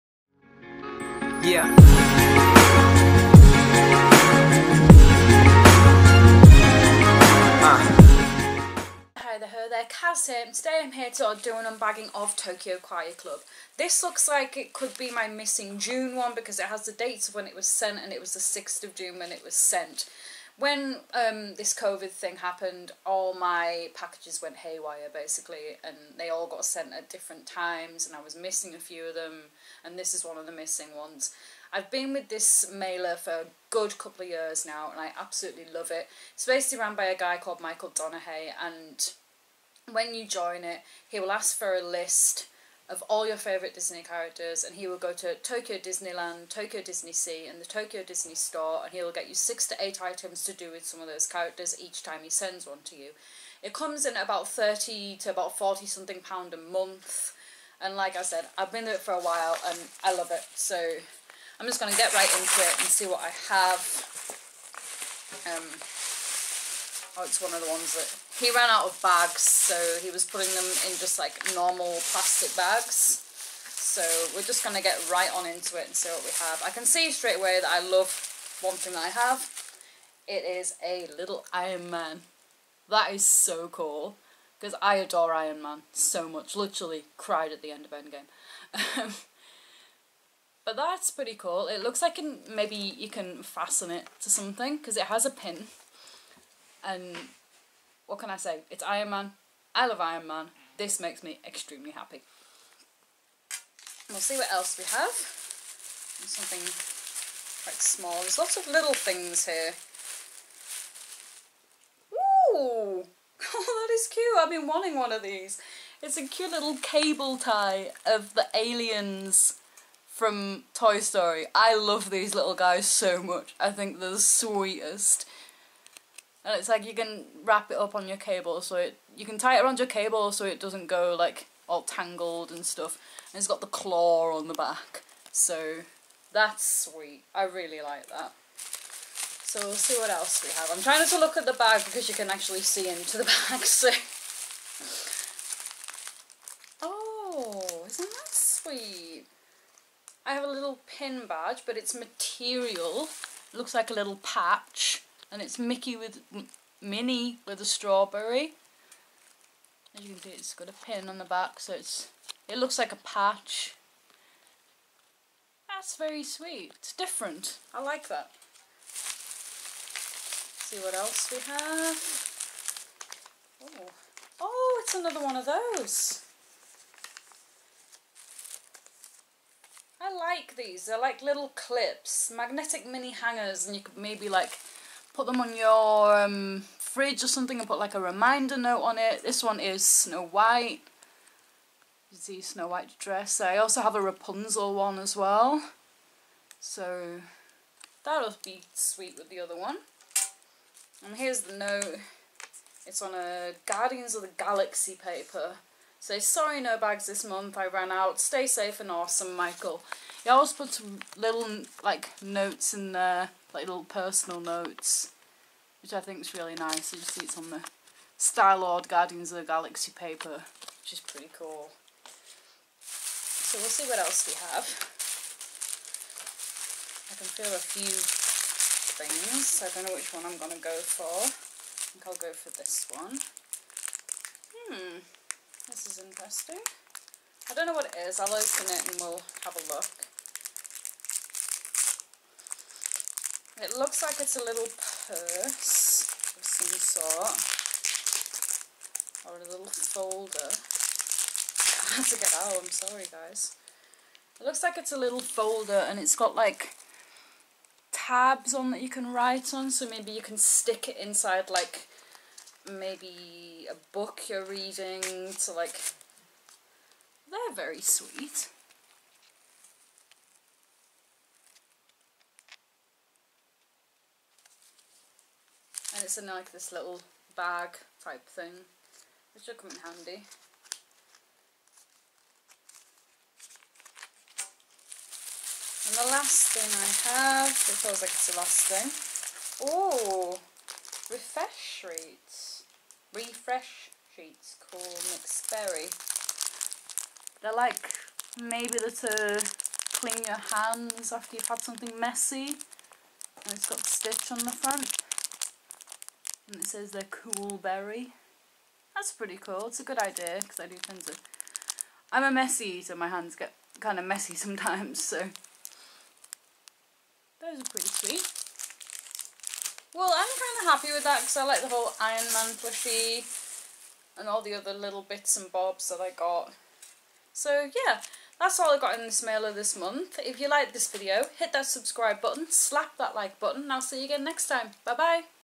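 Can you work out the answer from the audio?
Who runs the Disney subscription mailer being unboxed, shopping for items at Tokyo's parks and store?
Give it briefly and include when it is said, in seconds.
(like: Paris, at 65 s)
Michael Donahue, at 37 s.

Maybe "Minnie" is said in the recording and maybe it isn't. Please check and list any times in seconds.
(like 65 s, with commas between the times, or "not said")
156 s.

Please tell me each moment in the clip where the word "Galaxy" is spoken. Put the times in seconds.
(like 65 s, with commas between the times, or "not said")
204 s, 219 s.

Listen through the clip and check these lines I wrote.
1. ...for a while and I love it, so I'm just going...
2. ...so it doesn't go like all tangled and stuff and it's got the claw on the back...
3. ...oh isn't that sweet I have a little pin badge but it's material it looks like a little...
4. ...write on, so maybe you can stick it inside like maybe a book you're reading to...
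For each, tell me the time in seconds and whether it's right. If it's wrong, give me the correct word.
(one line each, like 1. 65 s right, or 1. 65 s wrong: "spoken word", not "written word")
1. 58 s right
2. 130 s right
3. 146 s right
4. 259 s right.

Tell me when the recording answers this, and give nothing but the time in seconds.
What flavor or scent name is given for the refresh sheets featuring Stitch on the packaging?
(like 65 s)
294 s.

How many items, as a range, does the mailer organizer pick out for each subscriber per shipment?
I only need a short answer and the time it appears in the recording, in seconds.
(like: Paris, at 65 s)
6 to 8, at 49 s.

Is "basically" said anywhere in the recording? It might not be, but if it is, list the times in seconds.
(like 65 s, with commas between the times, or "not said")
25 s, 36 s.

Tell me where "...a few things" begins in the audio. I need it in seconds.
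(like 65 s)
227 s.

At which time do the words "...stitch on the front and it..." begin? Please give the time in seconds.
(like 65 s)
303 s.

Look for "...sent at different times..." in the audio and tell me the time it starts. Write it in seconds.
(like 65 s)
26 s.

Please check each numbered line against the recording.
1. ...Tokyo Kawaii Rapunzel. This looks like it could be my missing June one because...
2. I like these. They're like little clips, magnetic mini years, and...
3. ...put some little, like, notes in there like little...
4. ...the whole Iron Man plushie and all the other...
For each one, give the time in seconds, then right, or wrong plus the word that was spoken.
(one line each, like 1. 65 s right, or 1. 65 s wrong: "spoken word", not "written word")
1. 12 s wrong: "Club", not "Rapunzel"
2. 180 s wrong: "hangers", not "years"
3. 210 s right
4. 321 s right.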